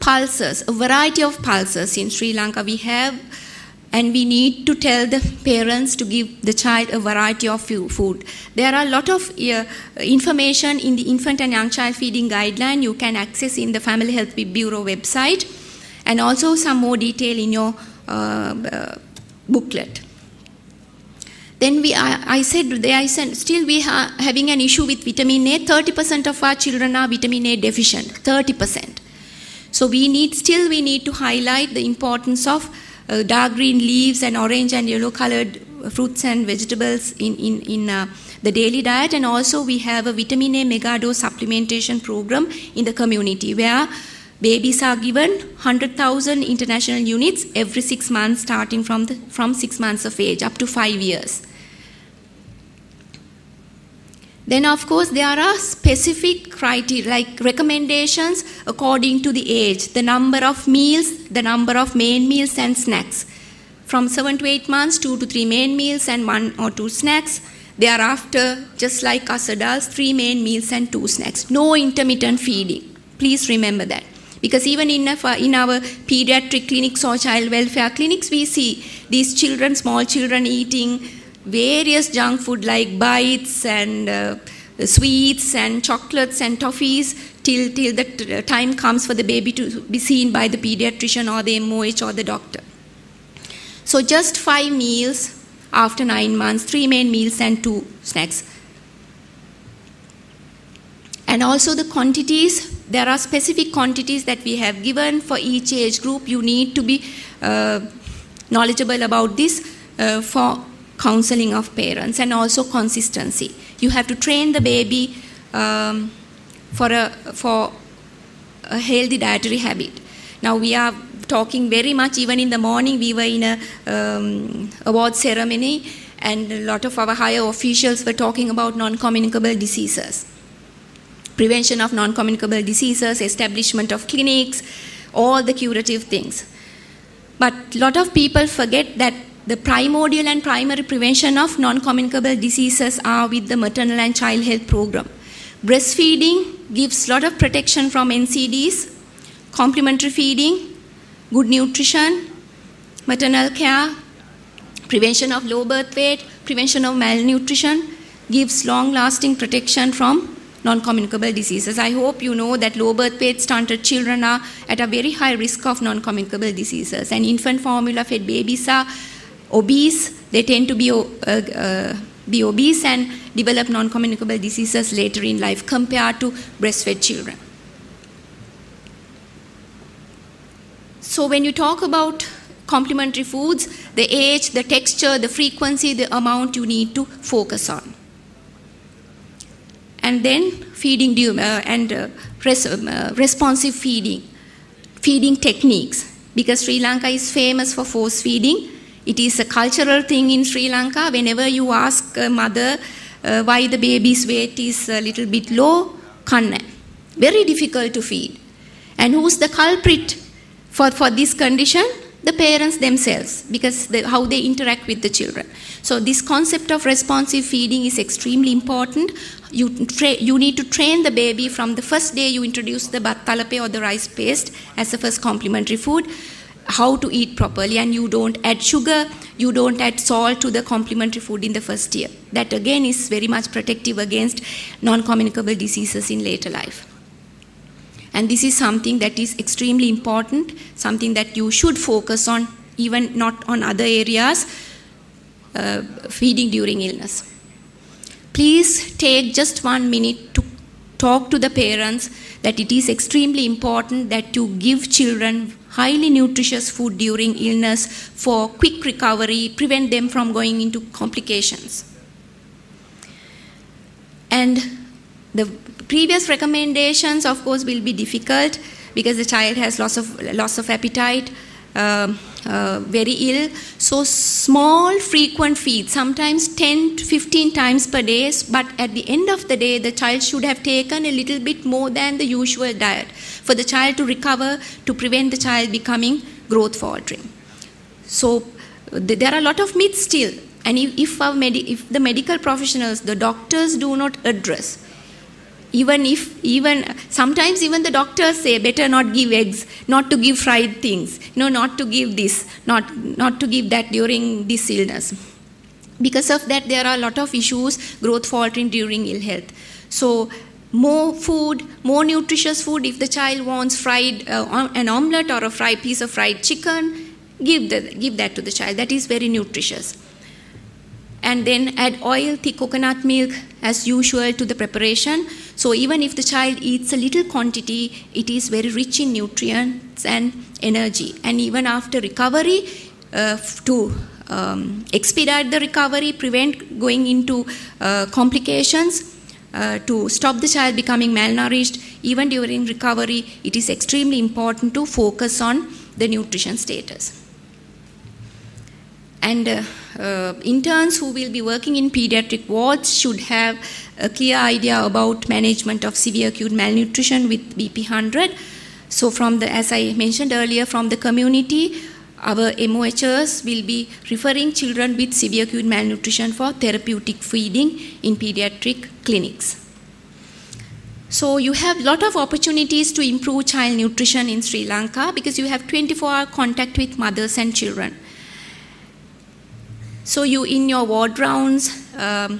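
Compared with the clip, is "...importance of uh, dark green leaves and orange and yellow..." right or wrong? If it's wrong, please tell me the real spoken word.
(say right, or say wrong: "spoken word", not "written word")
right.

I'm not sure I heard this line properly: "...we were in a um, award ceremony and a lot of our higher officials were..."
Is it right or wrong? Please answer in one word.
right.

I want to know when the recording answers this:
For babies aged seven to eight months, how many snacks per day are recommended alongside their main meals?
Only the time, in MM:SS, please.
01:06.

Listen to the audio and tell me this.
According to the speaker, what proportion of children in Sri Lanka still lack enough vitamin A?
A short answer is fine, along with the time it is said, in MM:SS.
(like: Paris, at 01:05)
30%, at 00:25.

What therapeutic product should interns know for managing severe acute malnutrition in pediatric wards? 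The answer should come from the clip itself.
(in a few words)
BP100.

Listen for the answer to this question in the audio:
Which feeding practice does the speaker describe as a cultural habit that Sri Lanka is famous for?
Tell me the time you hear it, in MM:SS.
03:17.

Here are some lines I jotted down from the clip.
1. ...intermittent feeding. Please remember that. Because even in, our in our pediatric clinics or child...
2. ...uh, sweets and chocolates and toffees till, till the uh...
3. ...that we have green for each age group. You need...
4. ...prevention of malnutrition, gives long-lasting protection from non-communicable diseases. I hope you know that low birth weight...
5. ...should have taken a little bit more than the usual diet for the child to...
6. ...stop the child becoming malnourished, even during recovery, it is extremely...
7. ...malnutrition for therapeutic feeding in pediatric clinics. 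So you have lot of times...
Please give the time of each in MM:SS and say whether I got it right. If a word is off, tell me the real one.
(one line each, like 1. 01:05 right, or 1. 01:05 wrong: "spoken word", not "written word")
1. 01:11 right
2. 01:24 right
3. 01:44 wrong: "given", not "green"
4. 02:36 right
5. 04:40 right
6. 05:40 right
7. 06:05 wrong: "opportunities", not "times".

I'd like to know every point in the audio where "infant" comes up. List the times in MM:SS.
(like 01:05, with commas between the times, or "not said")
00:11, 02:47.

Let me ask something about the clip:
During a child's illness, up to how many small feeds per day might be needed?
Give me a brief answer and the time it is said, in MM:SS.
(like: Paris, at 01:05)
10 to 15, at 04:36.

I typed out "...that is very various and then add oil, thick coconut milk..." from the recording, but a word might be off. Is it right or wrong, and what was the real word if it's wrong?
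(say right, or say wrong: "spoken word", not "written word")
wrong: "nutritious", not "various".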